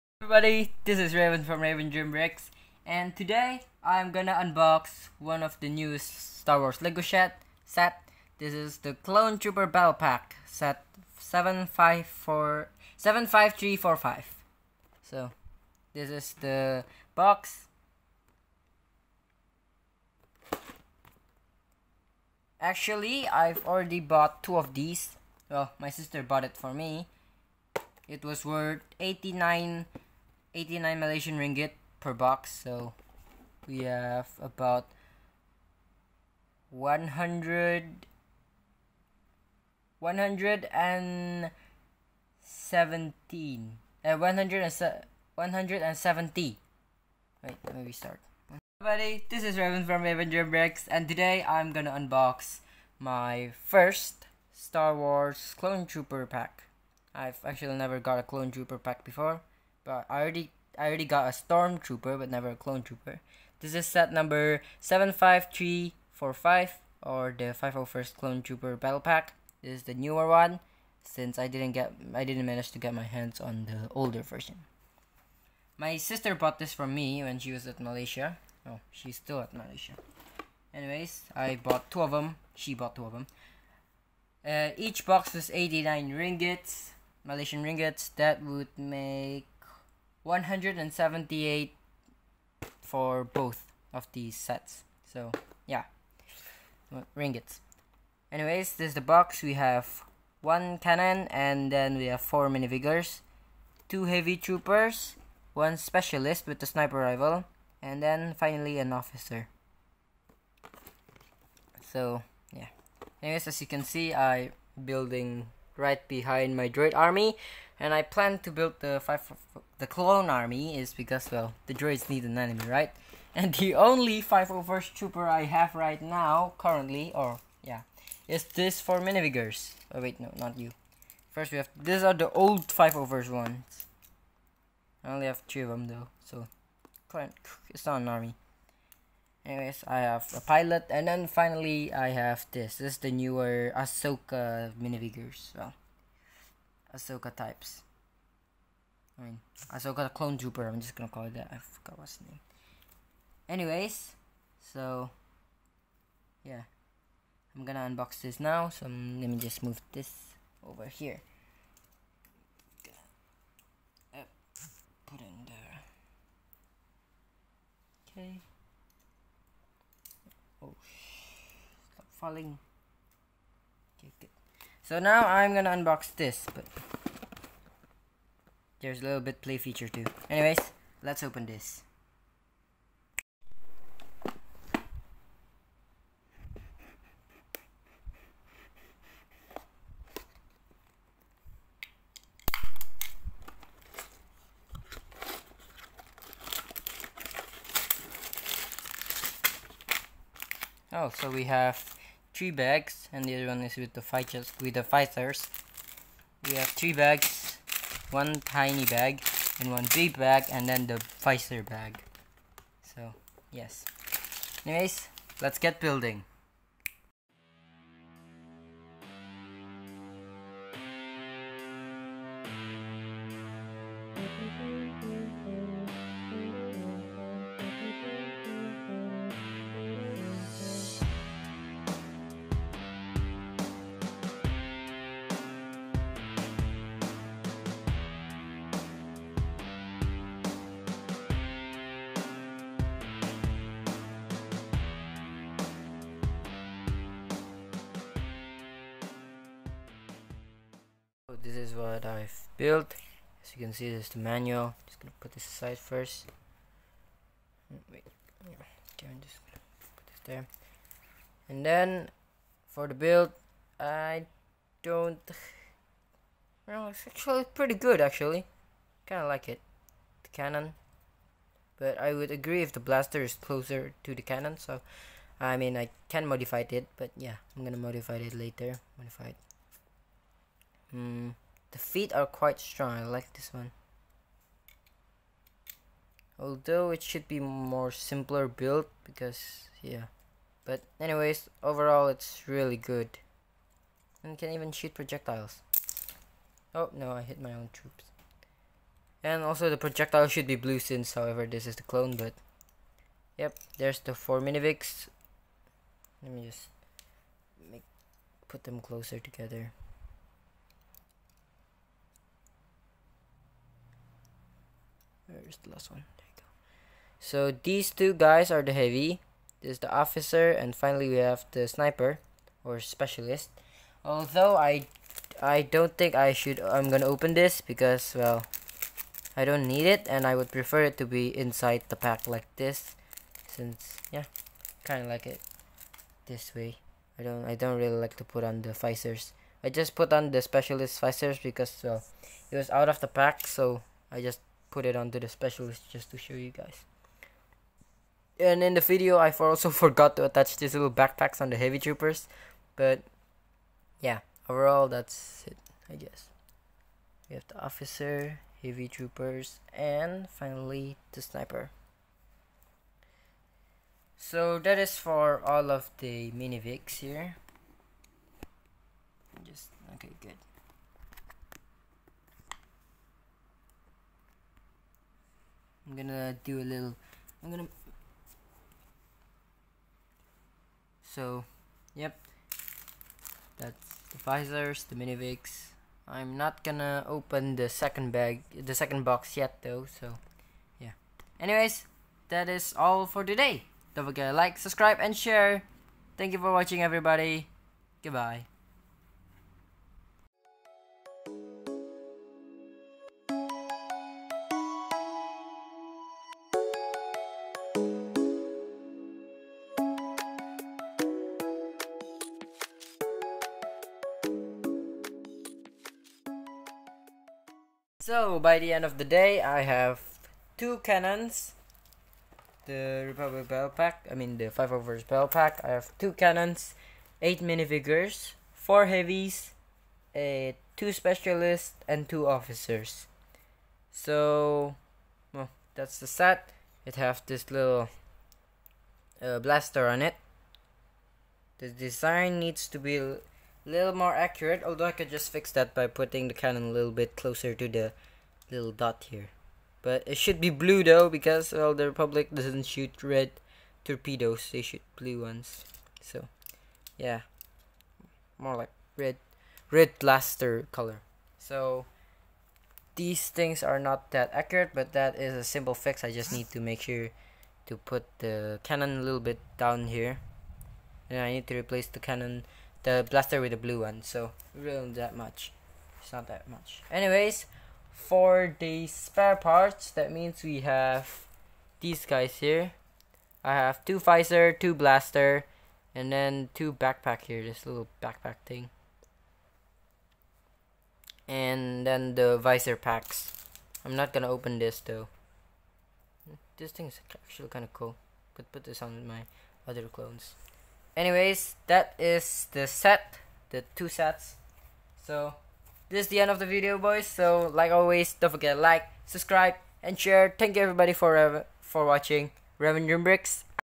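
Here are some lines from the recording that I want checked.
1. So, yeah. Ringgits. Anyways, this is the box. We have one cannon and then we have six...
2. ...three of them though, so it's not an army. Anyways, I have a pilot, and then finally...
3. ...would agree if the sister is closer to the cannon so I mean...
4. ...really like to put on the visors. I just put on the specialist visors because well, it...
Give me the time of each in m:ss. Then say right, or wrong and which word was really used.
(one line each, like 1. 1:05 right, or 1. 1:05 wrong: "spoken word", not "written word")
1. 1:35 wrong: "four", not "six"
2. 2:15 right
3. 4:32 wrong: "blaster", not "sister"
4. 5:37 right.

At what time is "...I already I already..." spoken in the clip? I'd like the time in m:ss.
1:00.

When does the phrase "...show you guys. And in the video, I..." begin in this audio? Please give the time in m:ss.
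5:46.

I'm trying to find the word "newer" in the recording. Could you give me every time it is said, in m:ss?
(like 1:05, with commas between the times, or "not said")
1:09, 2:23.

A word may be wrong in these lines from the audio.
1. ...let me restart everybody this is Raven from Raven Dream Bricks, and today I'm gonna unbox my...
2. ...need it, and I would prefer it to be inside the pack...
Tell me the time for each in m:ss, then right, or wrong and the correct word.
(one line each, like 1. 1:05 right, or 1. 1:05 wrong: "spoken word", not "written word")
1. 0:47 right
2. 5:29 right.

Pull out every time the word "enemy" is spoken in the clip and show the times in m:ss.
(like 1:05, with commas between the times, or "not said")
2:02.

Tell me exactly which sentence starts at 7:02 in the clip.
The Republic Battle Pack, I mean the 5 overs Battle Pack.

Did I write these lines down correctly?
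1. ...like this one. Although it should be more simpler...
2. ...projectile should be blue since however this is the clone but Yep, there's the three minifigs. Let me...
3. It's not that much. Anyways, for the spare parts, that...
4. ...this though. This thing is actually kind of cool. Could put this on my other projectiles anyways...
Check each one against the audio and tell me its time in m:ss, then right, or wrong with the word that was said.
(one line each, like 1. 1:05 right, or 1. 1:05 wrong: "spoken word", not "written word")
1. 4:43 right
2. 4:59 wrong: "four", not "three"
3. 7:56 right
4. 8:14 wrong: "clones", not "projectiles".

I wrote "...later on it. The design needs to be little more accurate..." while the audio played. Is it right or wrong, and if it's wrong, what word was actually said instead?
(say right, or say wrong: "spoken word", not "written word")
wrong: "blaster", not "later".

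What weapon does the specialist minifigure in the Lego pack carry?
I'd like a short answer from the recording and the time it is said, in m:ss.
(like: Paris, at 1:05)
Sniper rifle, at 1:46.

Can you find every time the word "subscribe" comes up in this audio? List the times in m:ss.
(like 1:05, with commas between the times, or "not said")
6:34, 8:29.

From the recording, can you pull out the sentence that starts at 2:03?
And the only 501st trooper I have right now, currently, or yeah, is this for minifigures.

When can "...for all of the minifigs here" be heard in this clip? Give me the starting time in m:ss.
6:04.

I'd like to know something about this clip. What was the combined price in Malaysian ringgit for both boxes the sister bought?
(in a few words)
178.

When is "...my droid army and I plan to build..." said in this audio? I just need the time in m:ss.
1:56.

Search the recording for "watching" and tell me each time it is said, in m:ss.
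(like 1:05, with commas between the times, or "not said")
6:36, 8:31.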